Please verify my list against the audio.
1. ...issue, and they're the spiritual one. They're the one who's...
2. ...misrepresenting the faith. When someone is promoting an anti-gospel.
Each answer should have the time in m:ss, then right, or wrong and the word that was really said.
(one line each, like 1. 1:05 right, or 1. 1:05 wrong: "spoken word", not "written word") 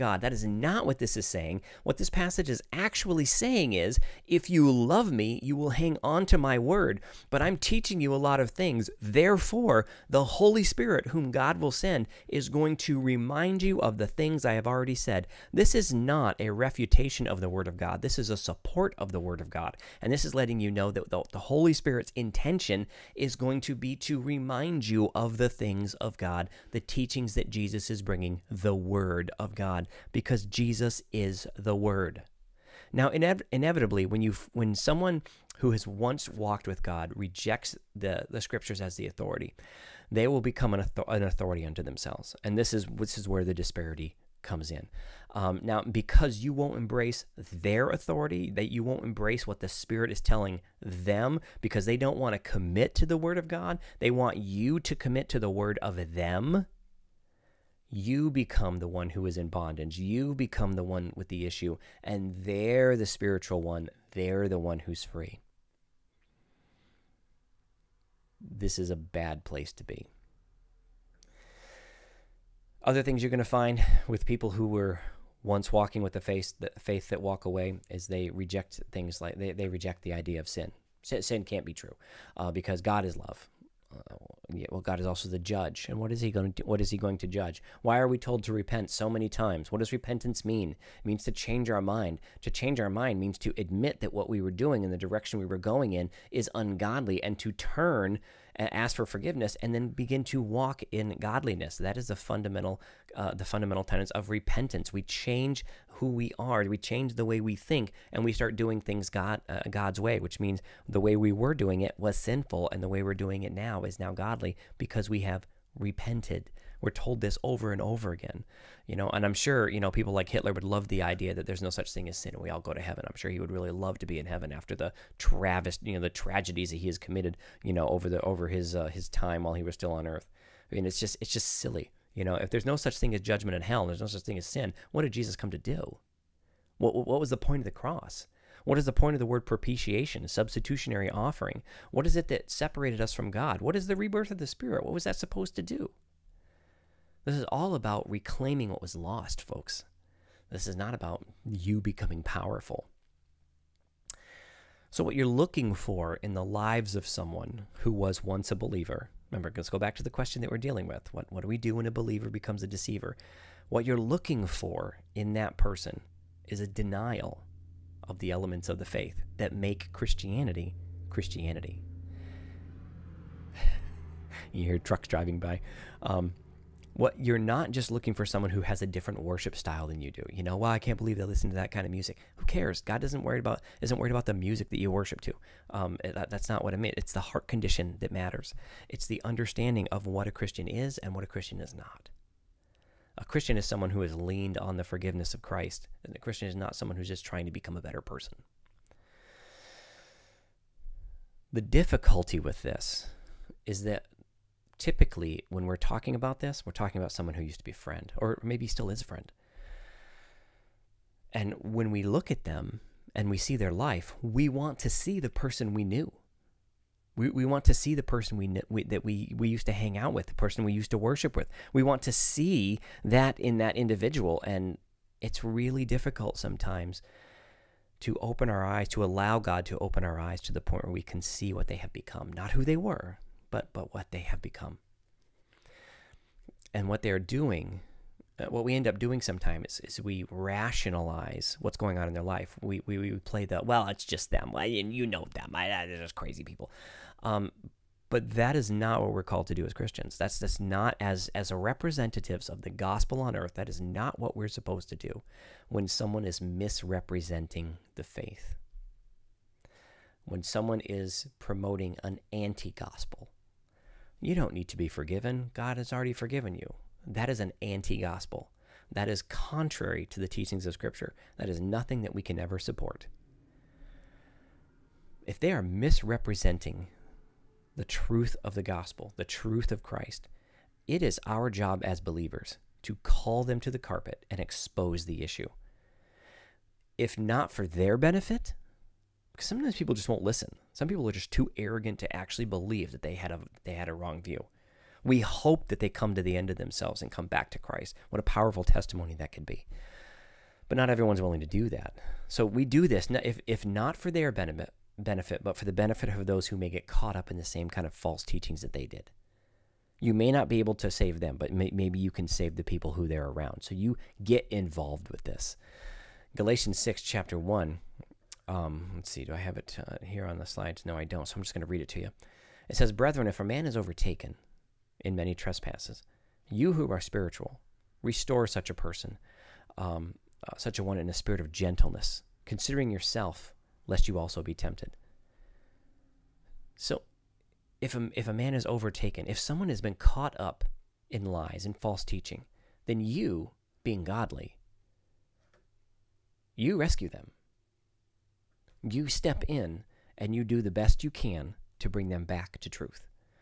1. 1:01 right
2. 4:16 right.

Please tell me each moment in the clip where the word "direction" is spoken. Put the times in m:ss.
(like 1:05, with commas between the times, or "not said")
1:34.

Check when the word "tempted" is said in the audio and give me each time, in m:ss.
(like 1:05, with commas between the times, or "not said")
5:34.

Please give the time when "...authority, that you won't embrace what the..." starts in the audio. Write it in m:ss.
0:47.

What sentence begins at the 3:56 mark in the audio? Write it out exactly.
And what they're doing, uh, what we end up doing sometimes is, is we rationalize what's going on in their life.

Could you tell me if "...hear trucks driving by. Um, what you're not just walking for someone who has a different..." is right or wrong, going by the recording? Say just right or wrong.
wrong.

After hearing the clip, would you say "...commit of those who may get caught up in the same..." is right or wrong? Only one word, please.
wrong.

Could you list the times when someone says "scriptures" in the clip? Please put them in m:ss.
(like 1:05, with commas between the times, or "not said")
0:38, 4:30.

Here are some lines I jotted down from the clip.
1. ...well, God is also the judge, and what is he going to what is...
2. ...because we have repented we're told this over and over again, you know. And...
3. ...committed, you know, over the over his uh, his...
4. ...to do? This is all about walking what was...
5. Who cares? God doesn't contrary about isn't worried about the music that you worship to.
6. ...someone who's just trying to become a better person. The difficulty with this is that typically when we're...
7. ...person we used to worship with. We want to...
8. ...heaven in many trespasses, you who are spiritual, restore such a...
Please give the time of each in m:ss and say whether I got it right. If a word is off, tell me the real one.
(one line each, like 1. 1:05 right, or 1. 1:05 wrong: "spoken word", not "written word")
1. 1:24 right
2. 1:54 right
3. 2:06 right
4. 2:25 wrong: "reclaiming", not "walking"
5. 3:02 wrong: "worry", not "contrary"
6. 3:16 right
7. 3:40 right
8. 5:23 wrong: "overtaken", not "heaven".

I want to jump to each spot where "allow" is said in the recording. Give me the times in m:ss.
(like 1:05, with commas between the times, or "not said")
3:49.